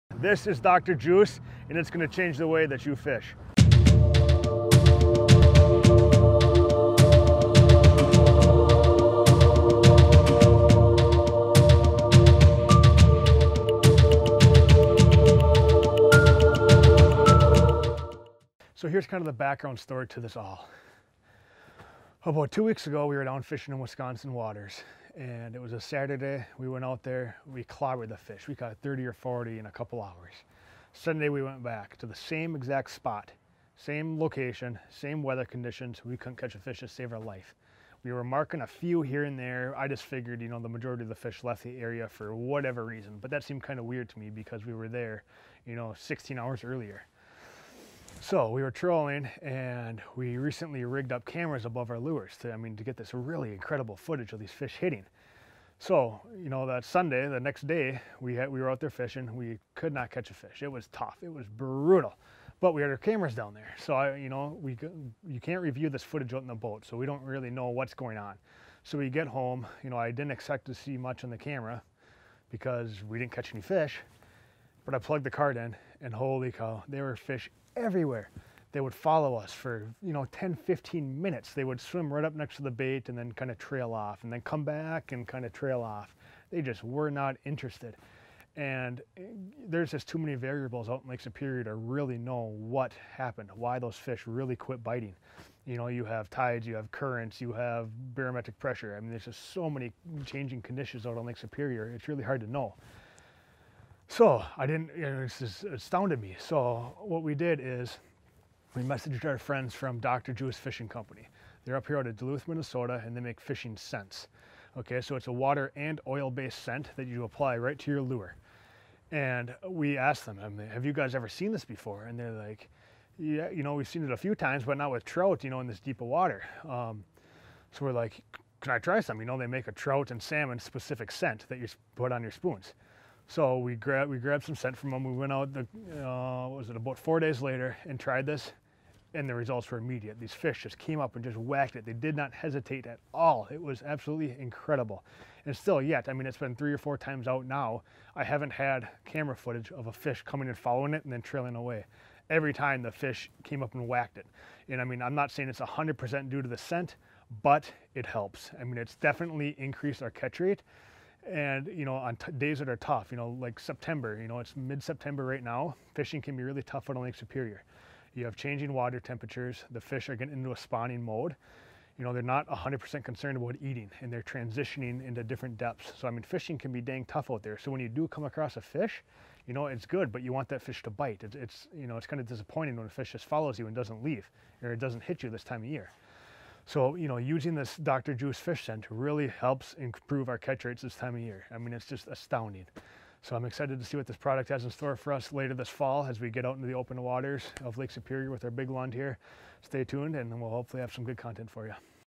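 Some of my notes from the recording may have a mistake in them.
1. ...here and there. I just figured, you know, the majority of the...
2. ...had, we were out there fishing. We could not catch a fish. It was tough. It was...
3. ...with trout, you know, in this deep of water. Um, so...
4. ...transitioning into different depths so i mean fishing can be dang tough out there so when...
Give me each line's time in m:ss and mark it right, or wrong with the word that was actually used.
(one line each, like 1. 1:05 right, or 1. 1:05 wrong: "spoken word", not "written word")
1. 0:39 right
2. 0:58 right
3. 2:04 right
4. 2:54 right.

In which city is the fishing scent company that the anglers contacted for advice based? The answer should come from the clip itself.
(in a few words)
Duluth, Minnesota.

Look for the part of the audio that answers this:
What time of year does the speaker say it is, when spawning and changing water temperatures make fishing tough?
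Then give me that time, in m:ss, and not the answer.
2:44.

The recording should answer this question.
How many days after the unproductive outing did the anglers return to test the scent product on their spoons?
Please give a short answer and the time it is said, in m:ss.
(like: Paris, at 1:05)
4, at 2:16.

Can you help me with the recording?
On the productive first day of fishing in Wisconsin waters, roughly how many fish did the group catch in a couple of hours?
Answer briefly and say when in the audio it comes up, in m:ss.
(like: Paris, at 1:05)
30 or 40, at 0:28.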